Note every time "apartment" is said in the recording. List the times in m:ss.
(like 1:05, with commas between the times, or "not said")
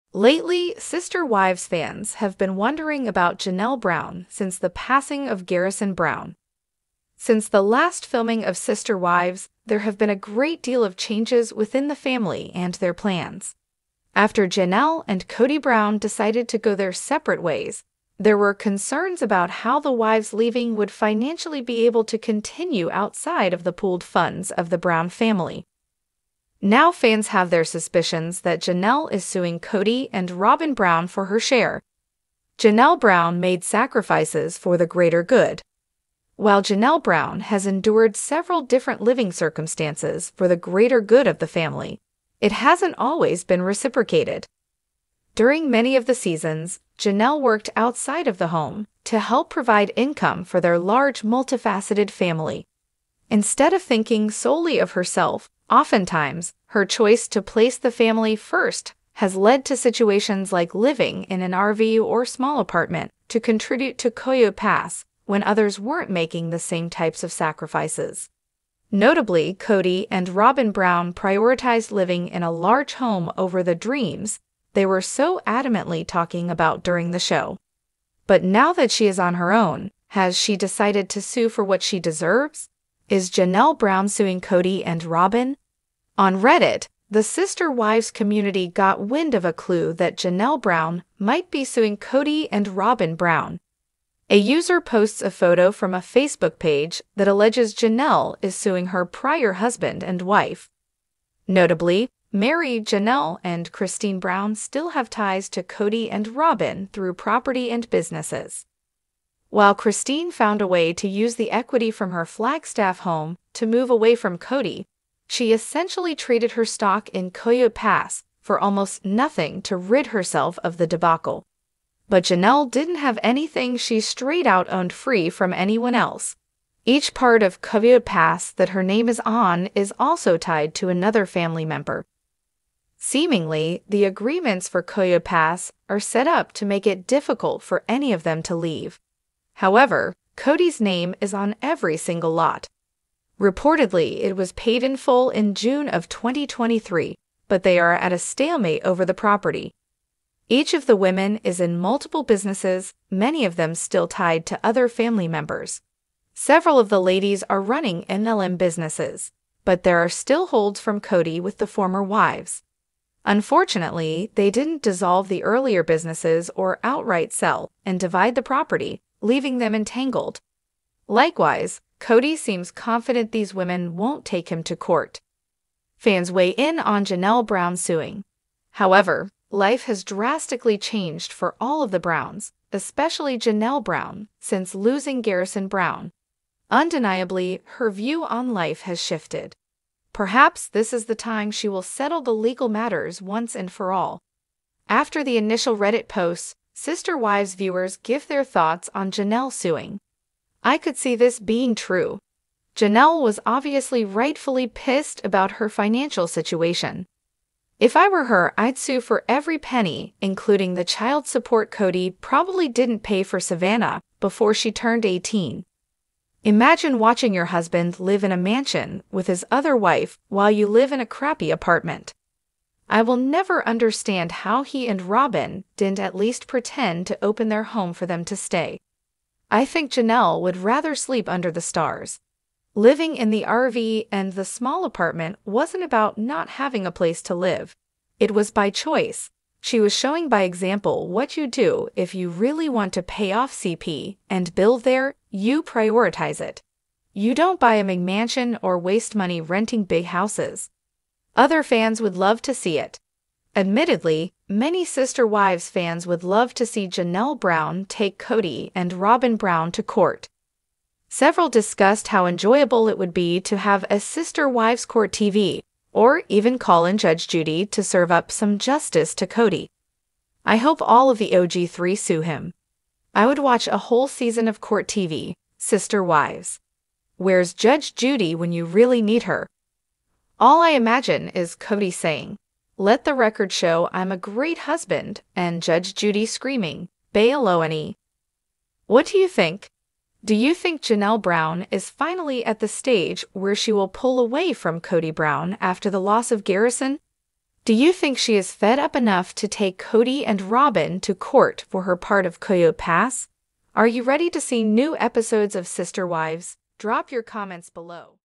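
1:02, 3:41, 3:54.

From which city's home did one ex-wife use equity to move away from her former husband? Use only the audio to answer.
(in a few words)
Flagstaff.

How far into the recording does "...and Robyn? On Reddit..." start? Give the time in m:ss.
1:24.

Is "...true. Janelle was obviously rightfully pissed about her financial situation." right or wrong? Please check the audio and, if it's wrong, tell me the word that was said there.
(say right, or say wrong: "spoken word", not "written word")
right.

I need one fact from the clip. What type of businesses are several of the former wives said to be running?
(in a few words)
MLM.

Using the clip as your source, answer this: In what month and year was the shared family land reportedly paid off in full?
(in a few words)
June 2023.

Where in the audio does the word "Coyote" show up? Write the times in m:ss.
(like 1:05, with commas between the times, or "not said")
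1:04, 1:57, 2:07, 2:14, 5:02.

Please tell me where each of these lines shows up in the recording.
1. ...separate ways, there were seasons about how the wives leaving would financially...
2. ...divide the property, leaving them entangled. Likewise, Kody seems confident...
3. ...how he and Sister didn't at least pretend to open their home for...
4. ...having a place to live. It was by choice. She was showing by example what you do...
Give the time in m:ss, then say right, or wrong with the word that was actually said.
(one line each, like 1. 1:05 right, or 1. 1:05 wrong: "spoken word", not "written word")
1. 0:16 wrong: "concerns", not "seasons"
2. 2:47 right
3. 3:44 wrong: "Robyn", not "Sister"
4. 3:56 right.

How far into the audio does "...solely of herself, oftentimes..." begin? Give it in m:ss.
0:54.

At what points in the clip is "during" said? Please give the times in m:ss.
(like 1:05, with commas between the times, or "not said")
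0:45, 1:16.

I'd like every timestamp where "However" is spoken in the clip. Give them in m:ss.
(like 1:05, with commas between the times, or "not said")
2:19, 2:58.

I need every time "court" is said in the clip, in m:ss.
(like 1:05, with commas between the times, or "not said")
2:54, 4:19, 4:24, 4:34, 5:01.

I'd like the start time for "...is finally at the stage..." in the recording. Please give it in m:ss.
4:51.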